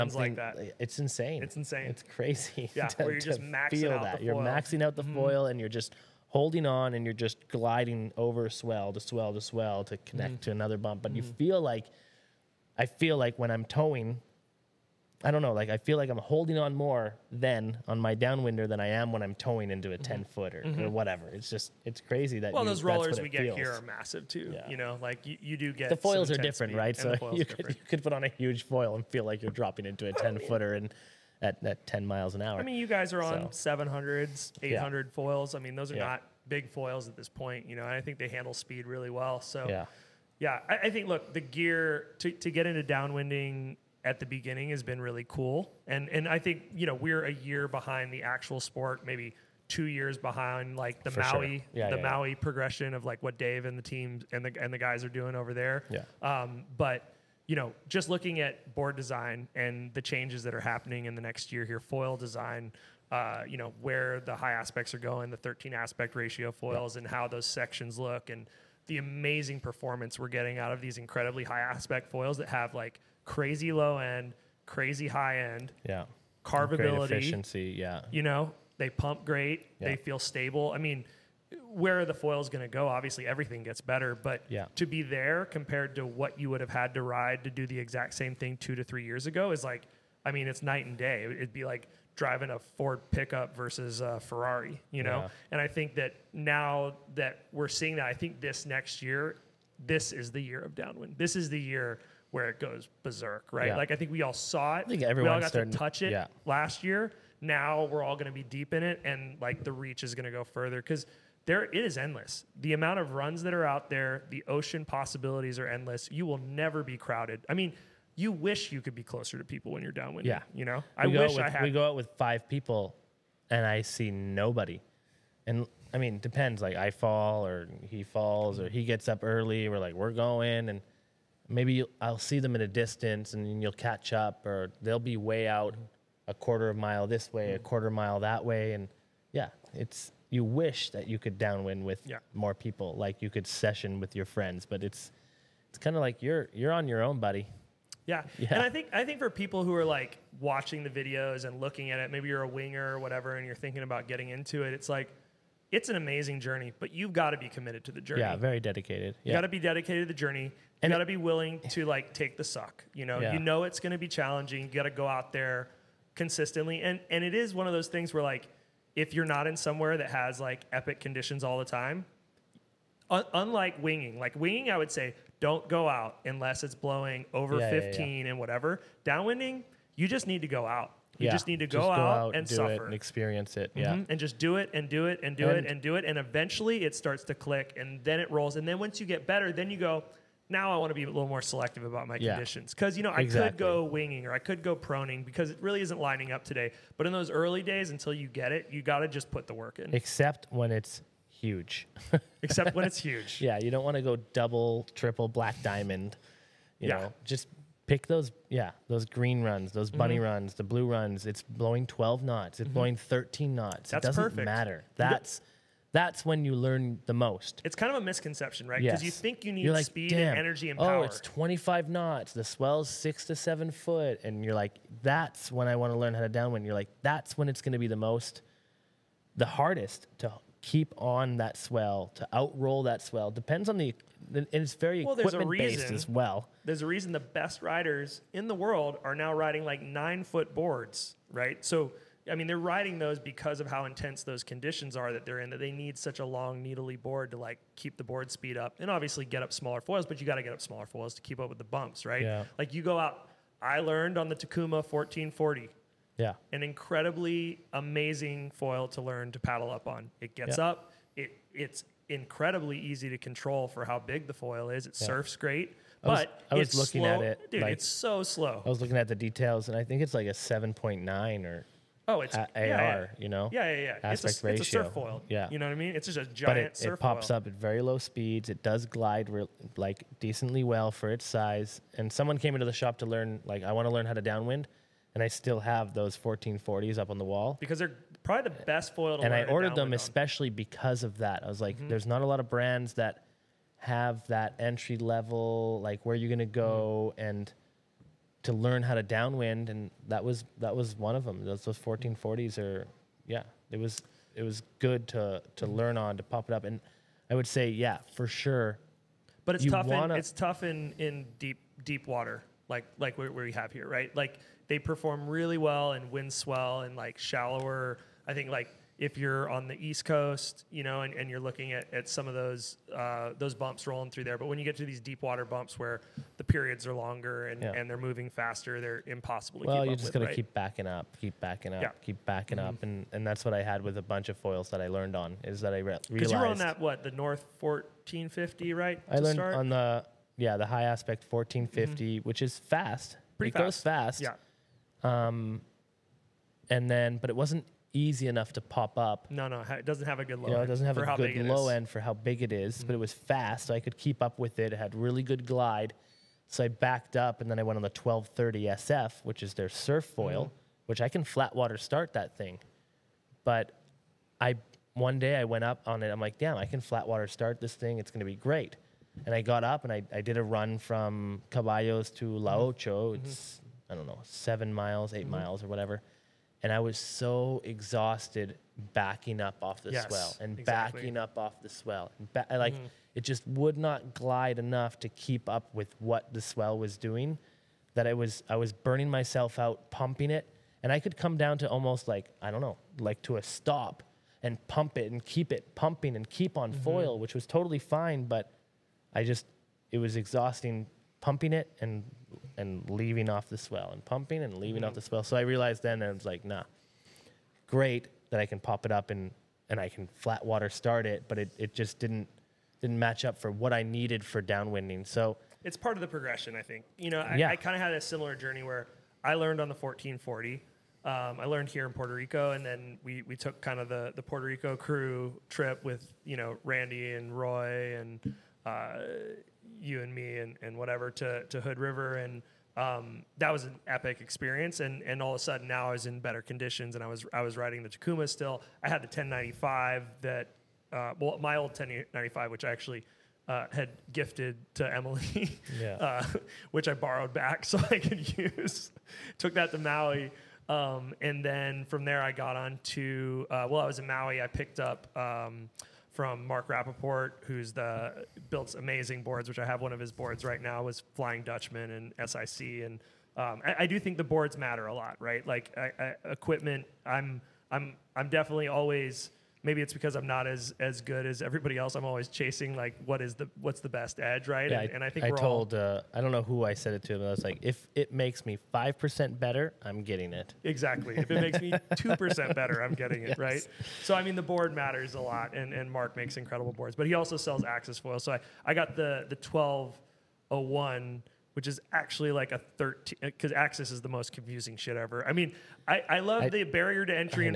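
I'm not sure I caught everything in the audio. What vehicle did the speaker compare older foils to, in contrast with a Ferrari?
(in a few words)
Ford pickup.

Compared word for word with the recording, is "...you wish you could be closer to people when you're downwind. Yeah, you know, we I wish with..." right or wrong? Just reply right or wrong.
right.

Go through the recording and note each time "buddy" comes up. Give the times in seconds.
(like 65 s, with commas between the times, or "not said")
147 s.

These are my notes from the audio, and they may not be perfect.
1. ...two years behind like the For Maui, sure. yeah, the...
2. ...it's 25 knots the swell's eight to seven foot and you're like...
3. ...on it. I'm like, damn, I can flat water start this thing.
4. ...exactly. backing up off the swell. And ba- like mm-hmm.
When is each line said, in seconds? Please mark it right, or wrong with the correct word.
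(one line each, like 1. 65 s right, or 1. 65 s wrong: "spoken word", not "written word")
1. 49 s right
2. 221 s wrong: "six", not "eight"
3. 365 s right
4. 380 s right.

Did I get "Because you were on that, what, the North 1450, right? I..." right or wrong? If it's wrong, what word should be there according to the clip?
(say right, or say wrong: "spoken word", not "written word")
right.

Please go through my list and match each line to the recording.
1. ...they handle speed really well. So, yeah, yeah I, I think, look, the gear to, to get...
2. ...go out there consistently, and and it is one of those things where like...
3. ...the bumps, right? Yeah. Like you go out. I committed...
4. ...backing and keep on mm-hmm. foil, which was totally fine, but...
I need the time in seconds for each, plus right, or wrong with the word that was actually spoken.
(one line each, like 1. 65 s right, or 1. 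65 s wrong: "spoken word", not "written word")
1. 38 s right
2. 164 s right
3. 251 s wrong: "learned", not "committed"
4. 395 s wrong: "pumping", not "backing".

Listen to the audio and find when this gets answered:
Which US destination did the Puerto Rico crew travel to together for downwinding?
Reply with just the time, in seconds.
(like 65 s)
431 s.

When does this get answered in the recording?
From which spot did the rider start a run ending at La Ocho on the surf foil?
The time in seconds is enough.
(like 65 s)
371 s.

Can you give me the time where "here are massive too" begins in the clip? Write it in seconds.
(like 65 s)
23 s.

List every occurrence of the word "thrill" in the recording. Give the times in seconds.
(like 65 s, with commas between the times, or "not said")
not said.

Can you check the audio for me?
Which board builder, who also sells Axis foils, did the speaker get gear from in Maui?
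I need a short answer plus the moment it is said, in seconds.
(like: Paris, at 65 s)
Mark Raaphorst, at 456 s.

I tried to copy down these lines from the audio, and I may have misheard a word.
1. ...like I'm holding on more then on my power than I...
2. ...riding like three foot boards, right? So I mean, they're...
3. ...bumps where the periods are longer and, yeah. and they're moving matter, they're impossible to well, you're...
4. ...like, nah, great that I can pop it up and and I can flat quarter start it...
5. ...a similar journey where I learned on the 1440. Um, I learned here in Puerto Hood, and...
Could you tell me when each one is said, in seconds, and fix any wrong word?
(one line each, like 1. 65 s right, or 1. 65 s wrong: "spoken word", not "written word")
1. 15 s wrong: "downwinder", not "power"
2. 239 s wrong: "nine", not "three"
3. 325 s wrong: "faster", not "matter"
4. 406 s wrong: "water", not "quarter"
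5. 417 s wrong: "Rico", not "Hood".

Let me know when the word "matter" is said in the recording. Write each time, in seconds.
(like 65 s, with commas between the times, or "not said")
214 s, 464 s, 484 s.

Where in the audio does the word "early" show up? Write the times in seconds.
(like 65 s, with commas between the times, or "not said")
129 s, 197 s.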